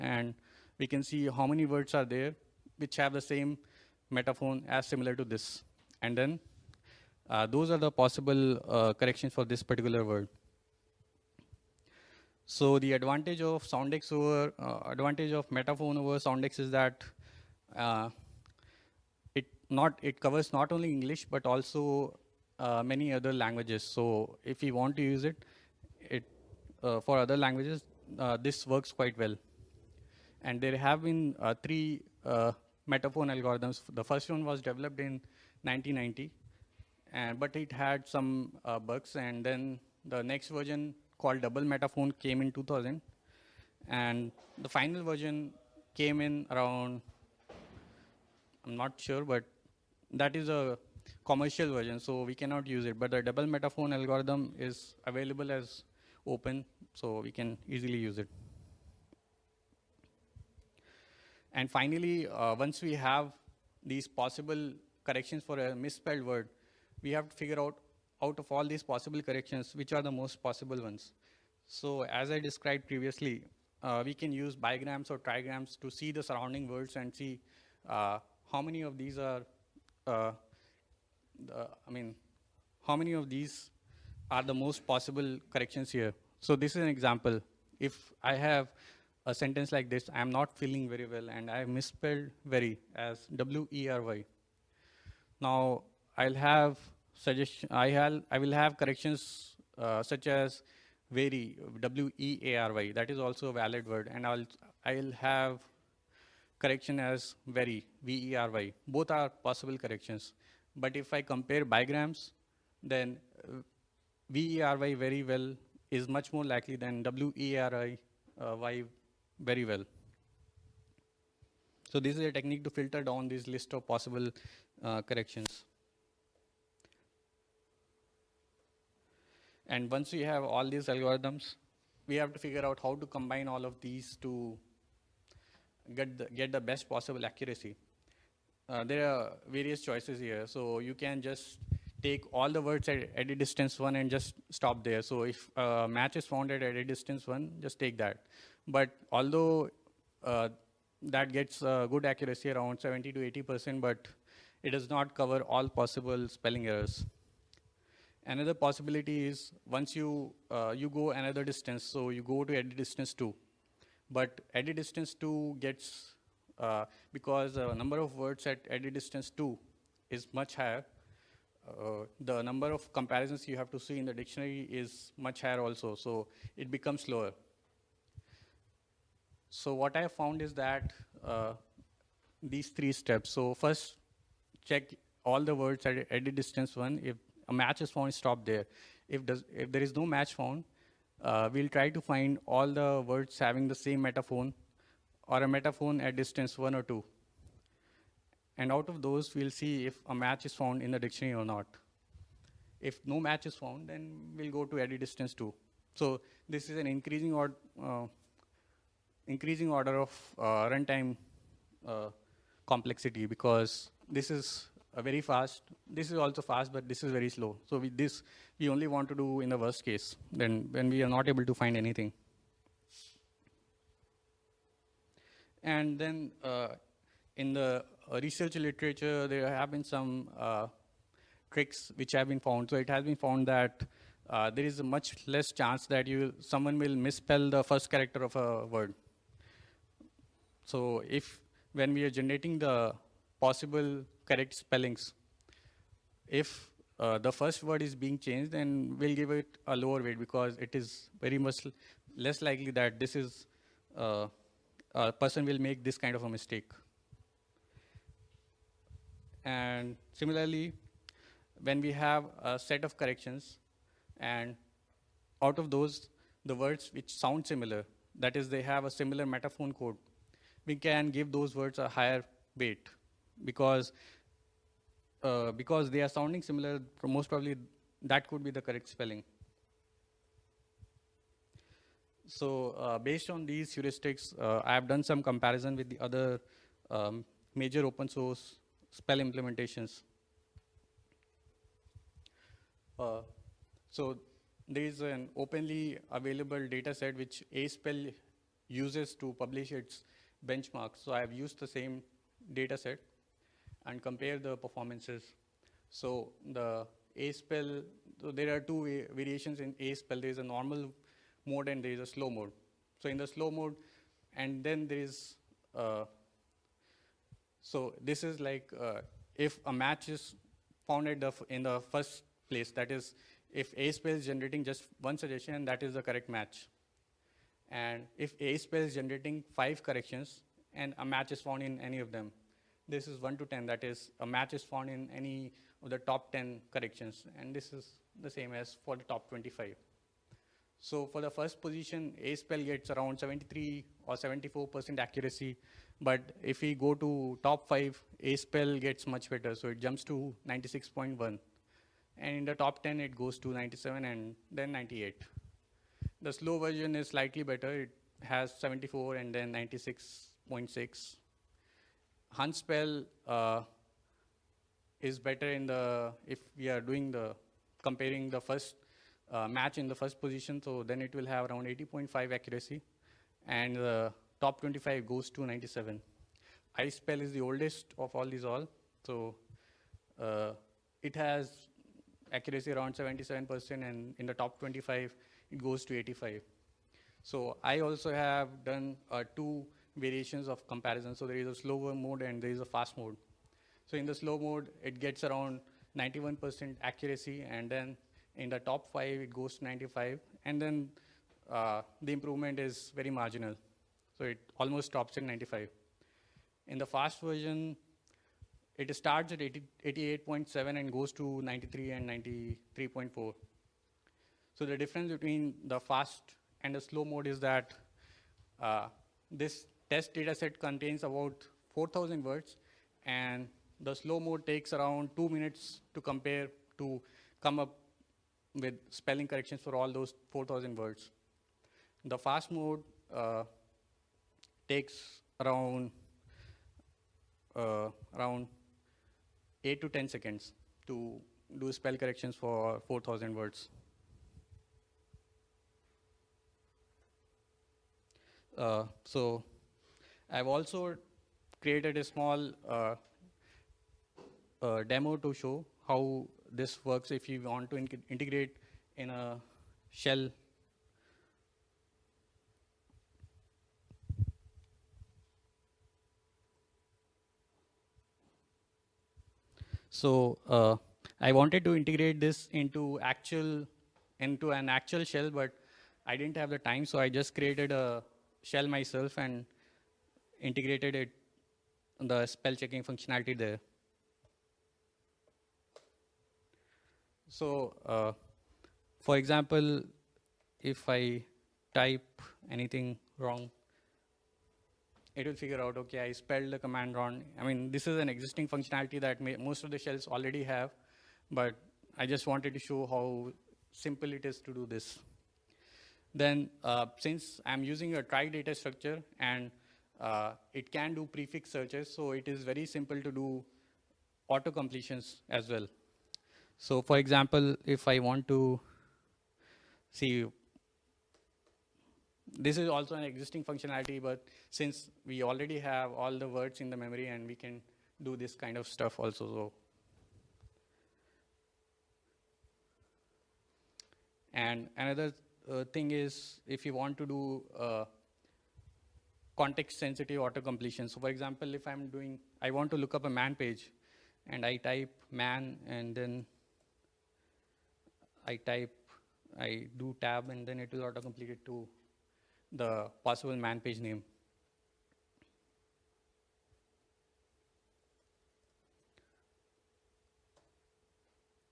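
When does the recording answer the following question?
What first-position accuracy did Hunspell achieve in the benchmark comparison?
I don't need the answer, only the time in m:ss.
6:11.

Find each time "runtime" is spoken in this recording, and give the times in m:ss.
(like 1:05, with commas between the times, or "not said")
3:30.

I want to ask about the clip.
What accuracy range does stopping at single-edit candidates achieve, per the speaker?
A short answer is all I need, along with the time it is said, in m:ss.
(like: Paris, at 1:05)
70 to 80%, at 2:32.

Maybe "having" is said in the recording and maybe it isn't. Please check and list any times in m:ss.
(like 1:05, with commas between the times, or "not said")
3:13.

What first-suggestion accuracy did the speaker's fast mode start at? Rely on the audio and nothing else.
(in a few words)
88.7.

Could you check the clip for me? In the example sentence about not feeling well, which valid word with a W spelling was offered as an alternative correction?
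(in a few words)
weary.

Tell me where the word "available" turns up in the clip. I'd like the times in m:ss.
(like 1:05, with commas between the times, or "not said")
0:55, 4:56.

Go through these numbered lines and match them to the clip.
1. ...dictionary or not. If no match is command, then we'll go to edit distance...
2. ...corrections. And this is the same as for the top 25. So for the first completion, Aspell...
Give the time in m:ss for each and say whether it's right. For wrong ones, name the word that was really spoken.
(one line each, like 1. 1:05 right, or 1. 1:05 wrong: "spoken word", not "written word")
1. 3:20 wrong: "found", not "command"
2. 5:36 wrong: "position", not "completion".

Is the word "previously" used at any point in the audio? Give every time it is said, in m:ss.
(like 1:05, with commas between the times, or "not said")
1:12.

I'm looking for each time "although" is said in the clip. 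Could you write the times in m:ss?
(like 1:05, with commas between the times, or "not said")
2:29.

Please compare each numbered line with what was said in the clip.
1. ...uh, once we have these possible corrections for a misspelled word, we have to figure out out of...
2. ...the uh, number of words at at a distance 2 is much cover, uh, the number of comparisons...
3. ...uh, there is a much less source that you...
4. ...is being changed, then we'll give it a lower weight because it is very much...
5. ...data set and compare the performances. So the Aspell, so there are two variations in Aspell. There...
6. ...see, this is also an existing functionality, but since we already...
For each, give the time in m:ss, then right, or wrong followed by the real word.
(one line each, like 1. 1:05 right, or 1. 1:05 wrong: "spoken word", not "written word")
1. 1:02 right
2. 2:47 wrong: "higher", not "cover"
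3. 3:54 wrong: "chance", not "source"
4. 4:07 right
5. 5:02 right
6. 8:39 right.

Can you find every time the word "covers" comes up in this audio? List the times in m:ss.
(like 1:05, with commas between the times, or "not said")
0:20, 2:35.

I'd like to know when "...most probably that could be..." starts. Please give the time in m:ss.
4:37.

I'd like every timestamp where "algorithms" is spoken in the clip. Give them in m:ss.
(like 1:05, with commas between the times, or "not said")
0:33, 0:53, 2:10.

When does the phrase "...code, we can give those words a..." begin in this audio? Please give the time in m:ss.
4:29.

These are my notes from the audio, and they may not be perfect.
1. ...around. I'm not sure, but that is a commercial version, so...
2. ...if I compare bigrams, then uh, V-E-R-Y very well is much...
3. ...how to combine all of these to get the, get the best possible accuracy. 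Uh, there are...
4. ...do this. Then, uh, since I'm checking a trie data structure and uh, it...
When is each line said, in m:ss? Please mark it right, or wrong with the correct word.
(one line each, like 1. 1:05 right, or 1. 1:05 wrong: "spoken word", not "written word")
1. 0:46 right
2. 1:50 right
3. 2:12 right
4. 8:24 wrong: "using", not "checking".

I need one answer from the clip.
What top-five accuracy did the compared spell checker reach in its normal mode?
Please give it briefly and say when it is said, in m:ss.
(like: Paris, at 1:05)
96.1, at 5:50.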